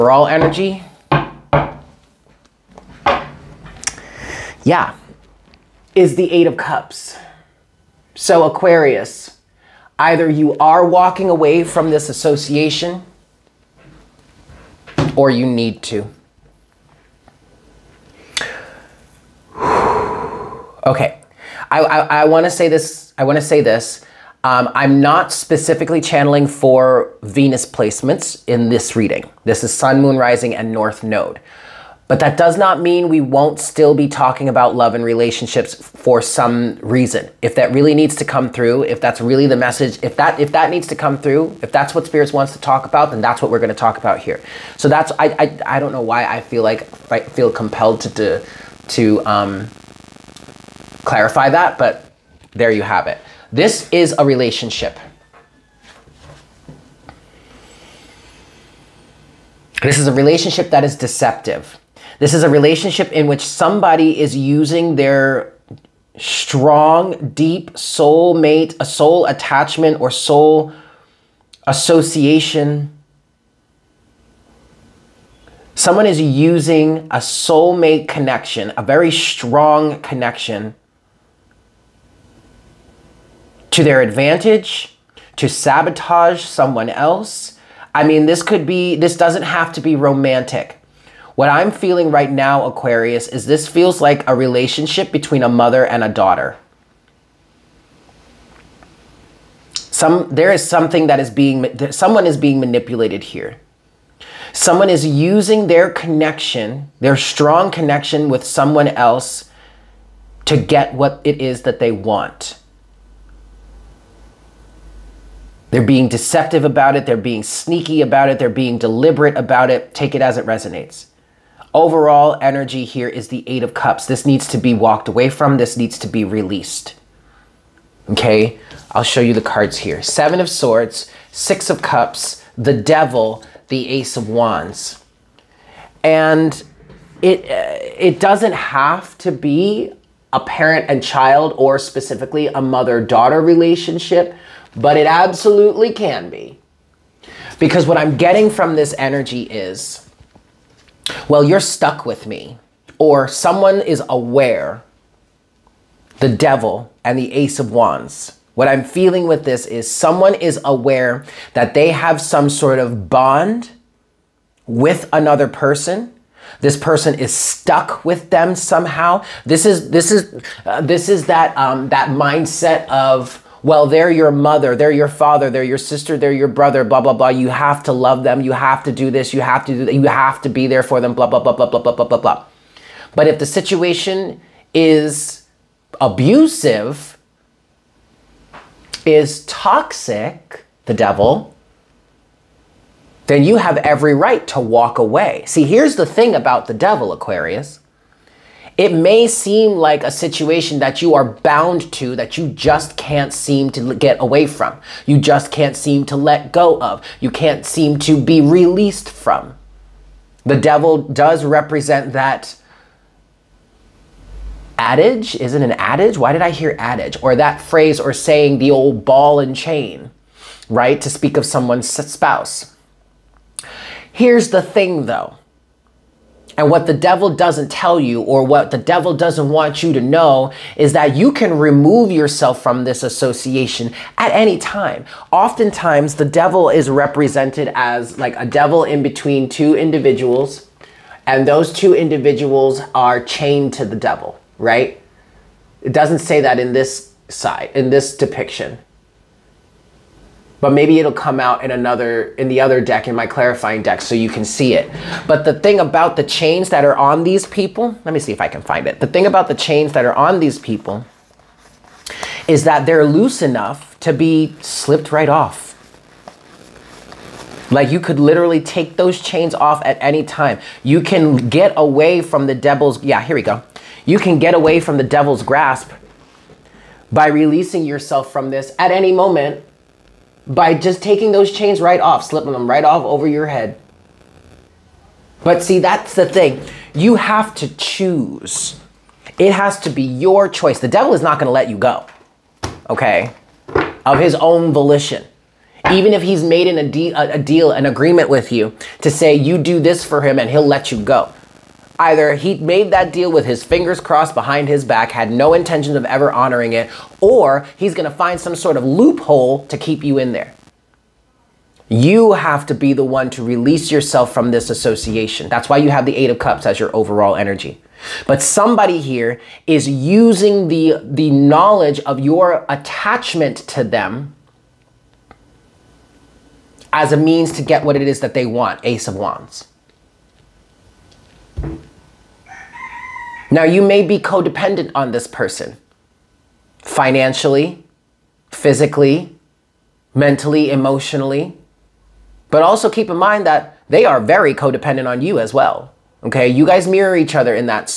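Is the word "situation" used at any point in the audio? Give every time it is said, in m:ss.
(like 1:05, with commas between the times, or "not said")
3:03, 3:20.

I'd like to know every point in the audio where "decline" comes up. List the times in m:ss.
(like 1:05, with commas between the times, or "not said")
not said.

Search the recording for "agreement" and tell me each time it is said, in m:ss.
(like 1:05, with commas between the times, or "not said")
4:57.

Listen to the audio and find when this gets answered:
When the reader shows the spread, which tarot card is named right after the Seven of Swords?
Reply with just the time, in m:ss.
2:11.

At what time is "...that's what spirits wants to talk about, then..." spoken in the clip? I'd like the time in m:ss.
0:41.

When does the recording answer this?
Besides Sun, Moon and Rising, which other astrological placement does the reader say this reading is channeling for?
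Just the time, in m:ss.
0:30.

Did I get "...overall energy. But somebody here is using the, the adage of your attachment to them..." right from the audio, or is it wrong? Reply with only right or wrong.
wrong.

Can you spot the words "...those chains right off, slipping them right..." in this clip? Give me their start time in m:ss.
4:41.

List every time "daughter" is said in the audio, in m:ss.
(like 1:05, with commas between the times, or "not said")
1:36, 2:22.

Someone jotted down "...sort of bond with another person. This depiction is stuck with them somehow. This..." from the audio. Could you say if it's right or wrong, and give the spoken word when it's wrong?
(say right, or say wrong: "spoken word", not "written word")
wrong: "person", not "depiction".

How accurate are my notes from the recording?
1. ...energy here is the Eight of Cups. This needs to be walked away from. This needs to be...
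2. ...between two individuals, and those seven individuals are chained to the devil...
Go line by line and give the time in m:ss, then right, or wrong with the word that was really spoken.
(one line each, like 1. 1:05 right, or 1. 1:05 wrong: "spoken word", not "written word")
1. 2:02 right
2. 3:59 wrong: "two", not "seven".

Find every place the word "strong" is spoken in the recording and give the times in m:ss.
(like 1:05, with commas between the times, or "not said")
1:06, 1:19, 1:47.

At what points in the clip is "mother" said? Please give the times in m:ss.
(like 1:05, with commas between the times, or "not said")
1:35, 2:22, 2:54.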